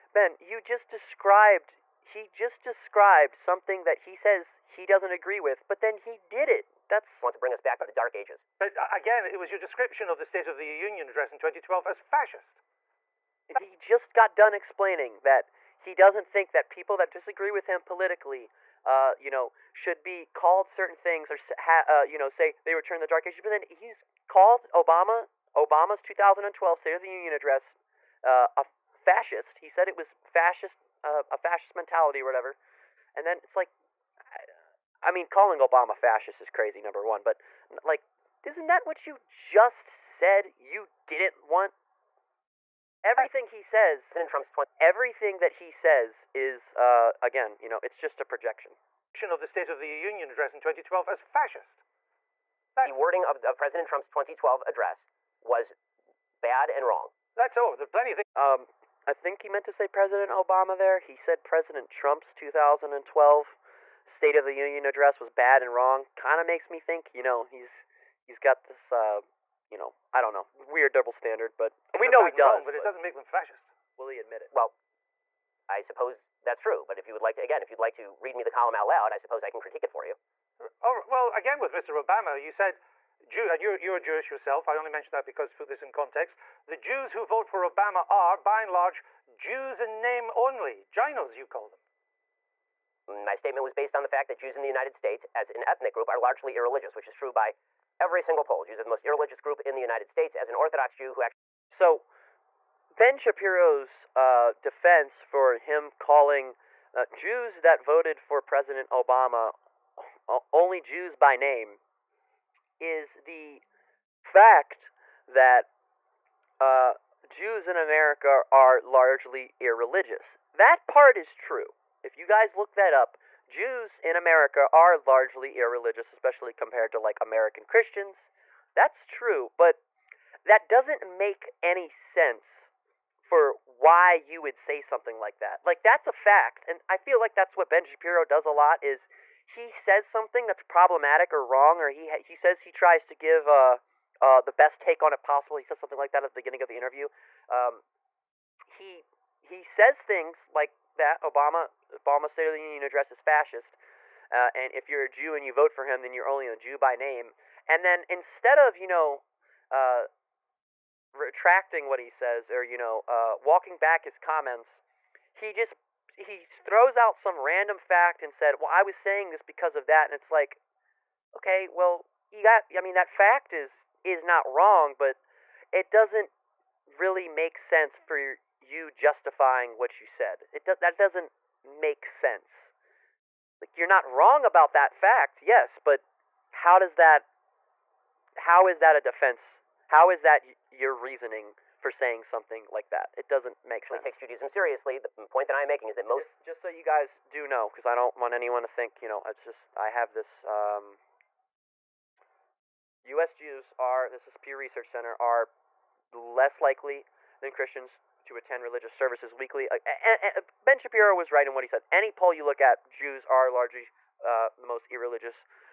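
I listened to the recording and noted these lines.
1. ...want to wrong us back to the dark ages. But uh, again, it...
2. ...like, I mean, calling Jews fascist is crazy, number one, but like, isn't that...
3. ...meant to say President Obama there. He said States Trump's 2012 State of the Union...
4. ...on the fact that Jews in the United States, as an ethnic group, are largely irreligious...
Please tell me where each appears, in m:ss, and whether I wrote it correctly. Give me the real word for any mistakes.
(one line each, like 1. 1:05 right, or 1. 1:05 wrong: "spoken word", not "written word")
1. 0:07 wrong: "bring", not "wrong"
2. 0:33 wrong: "Obama", not "Jews"
3. 0:59 wrong: "President", not "States"
4. 1:33 right.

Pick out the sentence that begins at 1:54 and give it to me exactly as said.
fact that uh, Jews in America are largely irreligious.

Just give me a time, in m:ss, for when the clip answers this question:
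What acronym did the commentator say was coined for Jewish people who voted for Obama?
1:30.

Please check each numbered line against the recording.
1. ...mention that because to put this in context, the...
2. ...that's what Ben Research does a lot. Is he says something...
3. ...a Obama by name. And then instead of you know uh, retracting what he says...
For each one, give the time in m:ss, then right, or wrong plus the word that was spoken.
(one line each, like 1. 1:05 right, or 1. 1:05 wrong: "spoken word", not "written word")
1. 1:24 right
2. 2:17 wrong: "Shapiro", not "Research"
3. 2:36 wrong: "Jew", not "Obama".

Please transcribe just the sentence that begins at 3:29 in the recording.
Uh, uh, ben Shapiro was right in what he said.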